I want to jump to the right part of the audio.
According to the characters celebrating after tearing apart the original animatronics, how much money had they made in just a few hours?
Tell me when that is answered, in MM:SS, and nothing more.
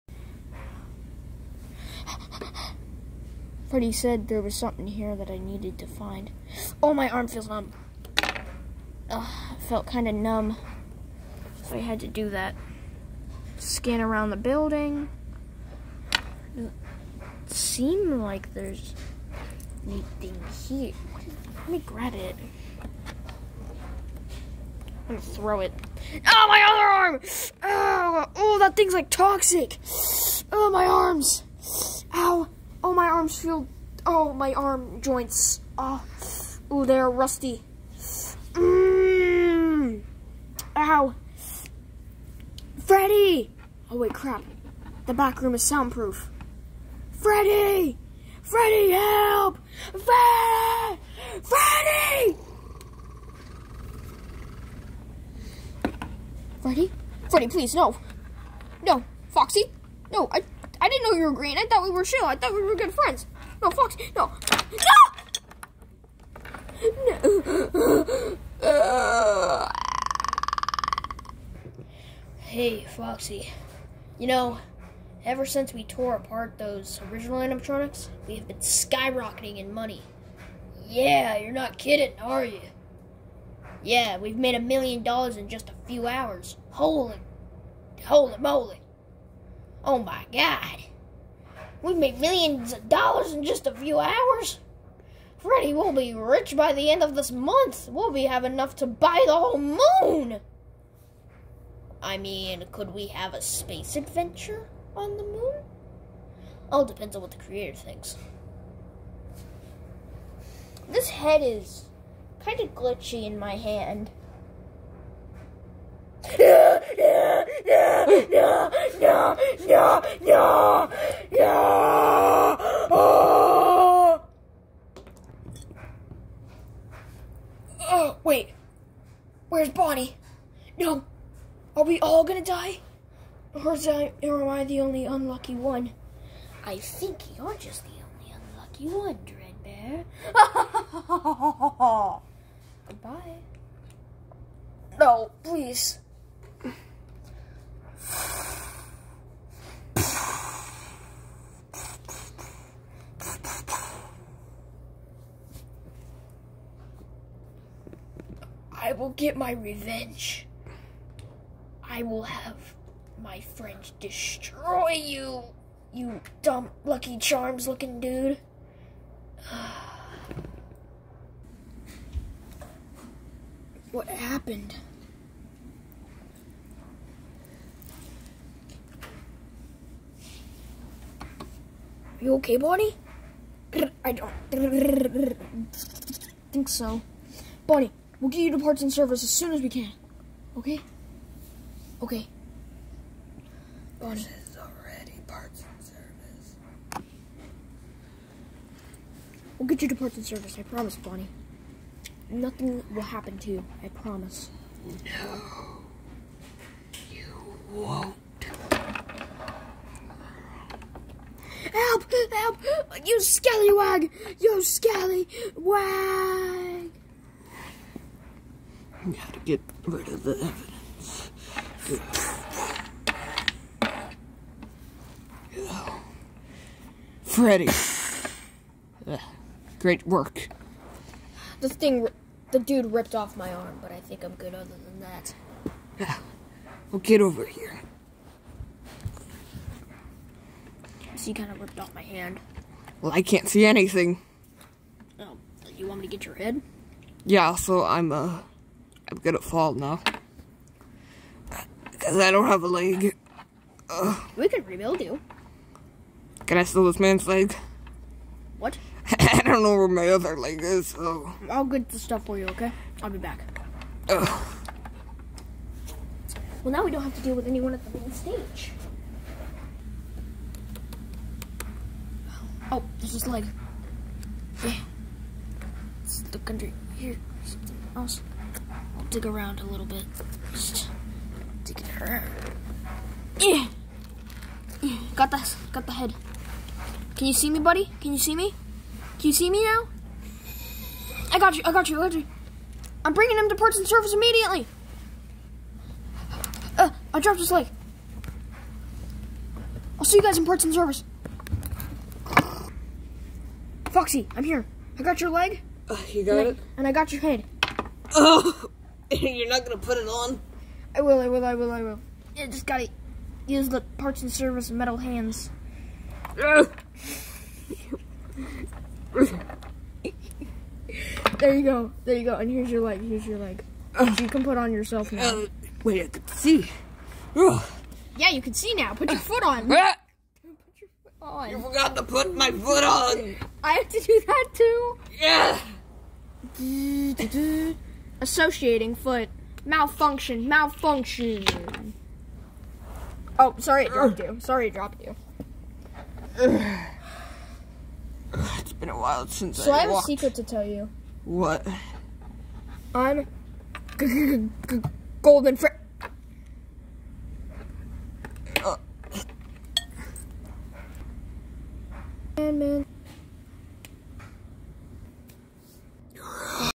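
01:24.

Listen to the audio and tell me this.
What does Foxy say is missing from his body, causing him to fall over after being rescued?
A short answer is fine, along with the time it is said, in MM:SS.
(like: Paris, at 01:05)
a leg, at 04:12.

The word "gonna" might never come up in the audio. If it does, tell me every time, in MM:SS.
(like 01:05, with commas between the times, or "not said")
00:25, 02:12, 04:09, 05:09.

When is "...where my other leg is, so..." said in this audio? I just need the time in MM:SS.
04:19.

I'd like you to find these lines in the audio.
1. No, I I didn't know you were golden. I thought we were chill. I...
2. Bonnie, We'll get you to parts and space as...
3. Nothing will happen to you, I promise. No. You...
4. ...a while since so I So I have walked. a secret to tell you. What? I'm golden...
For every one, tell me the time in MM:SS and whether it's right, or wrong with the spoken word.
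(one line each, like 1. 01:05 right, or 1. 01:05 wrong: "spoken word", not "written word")
1. 01:00 wrong: "green", not "golden"
2. 03:07 wrong: "service", not "space"
3. 03:22 right
4. 05:48 right.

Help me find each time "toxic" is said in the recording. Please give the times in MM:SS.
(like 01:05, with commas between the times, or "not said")
00:29.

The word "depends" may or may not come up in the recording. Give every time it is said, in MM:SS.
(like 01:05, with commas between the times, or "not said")
01:46.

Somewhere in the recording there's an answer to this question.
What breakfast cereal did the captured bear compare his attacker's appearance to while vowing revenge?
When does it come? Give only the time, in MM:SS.
02:46.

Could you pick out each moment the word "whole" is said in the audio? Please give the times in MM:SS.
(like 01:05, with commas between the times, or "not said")
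01:39.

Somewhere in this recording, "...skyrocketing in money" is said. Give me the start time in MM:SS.
01:18.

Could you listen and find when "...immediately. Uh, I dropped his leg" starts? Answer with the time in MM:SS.
04:54.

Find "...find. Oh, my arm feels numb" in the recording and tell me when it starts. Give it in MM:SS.
00:05.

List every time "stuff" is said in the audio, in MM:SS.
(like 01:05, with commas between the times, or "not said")
04:21.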